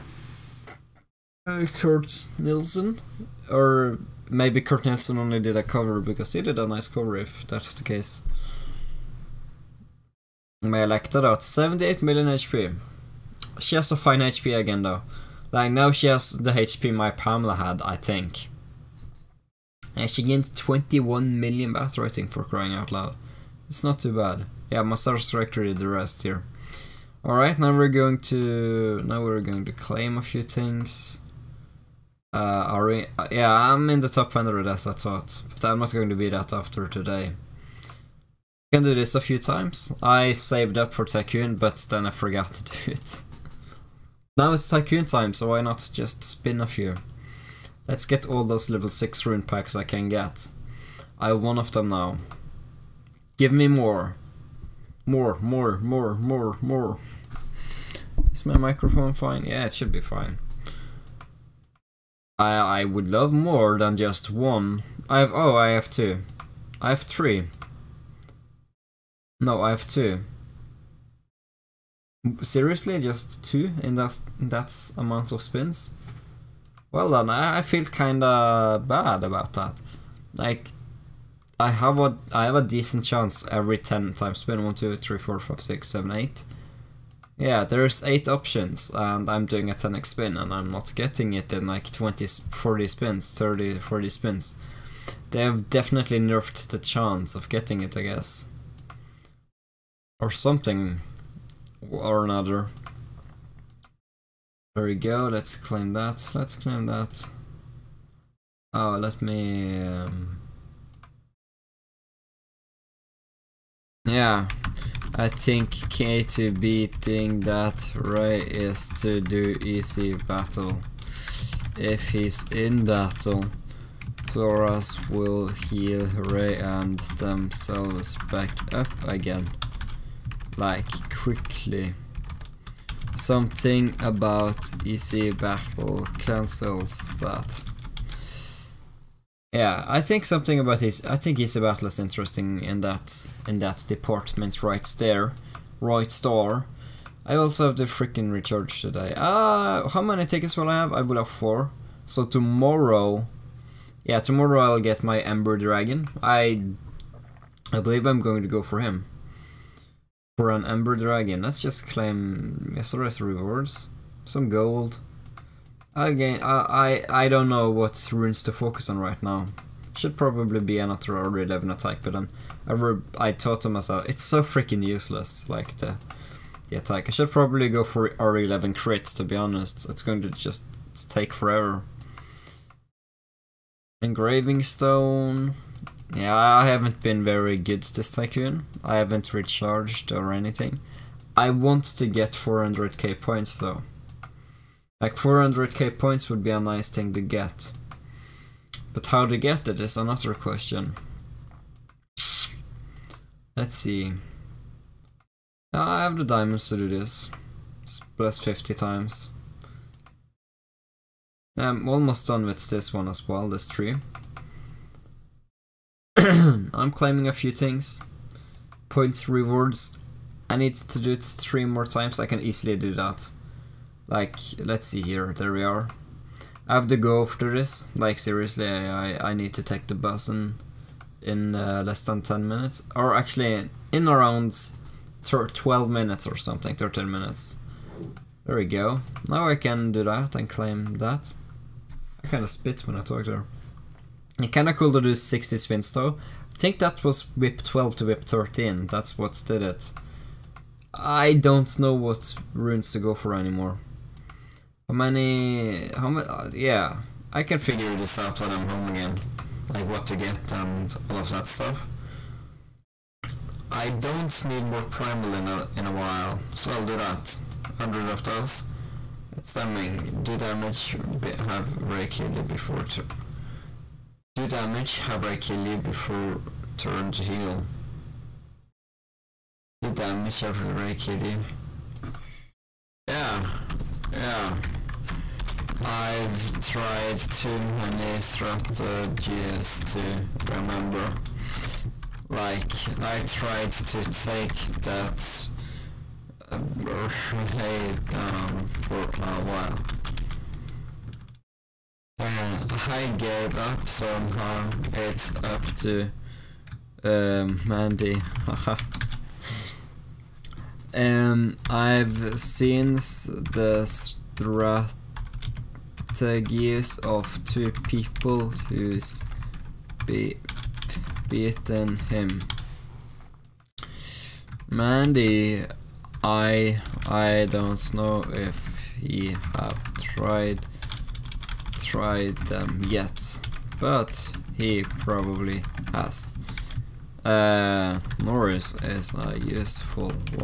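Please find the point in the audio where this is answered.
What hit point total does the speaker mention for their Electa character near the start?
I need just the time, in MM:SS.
00:11.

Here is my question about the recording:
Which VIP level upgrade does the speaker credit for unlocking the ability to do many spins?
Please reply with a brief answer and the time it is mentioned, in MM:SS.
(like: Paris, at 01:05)
VIP 12 to VIP 13, at 04:07.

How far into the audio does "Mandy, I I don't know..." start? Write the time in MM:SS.
05:24.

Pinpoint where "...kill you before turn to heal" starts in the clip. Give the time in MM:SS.
04:35.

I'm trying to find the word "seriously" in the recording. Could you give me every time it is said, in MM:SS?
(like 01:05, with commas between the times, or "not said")
01:12, 03:48.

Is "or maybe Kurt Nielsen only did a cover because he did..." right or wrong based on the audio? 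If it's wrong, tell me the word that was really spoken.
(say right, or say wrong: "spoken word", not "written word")
right.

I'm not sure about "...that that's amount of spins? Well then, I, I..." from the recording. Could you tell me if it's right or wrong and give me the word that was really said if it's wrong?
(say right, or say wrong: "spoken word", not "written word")
right.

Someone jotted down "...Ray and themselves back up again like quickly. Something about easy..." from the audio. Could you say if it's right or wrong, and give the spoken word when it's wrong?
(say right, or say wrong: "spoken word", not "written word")
right.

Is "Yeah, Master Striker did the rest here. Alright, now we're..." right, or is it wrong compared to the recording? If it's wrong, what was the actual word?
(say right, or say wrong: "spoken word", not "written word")
right.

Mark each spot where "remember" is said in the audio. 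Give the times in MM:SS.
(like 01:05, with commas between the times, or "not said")
04:50.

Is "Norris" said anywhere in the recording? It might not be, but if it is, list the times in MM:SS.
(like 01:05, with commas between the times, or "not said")
05:38.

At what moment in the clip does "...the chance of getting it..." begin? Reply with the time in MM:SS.
01:36.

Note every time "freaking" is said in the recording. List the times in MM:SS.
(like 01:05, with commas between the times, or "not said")
02:27, 02:54.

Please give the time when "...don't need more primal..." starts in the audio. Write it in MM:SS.
04:23.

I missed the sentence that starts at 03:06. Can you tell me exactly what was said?
Yeah, I haven't been very good this Tycoon.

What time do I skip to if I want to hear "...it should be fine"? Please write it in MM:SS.
00:59.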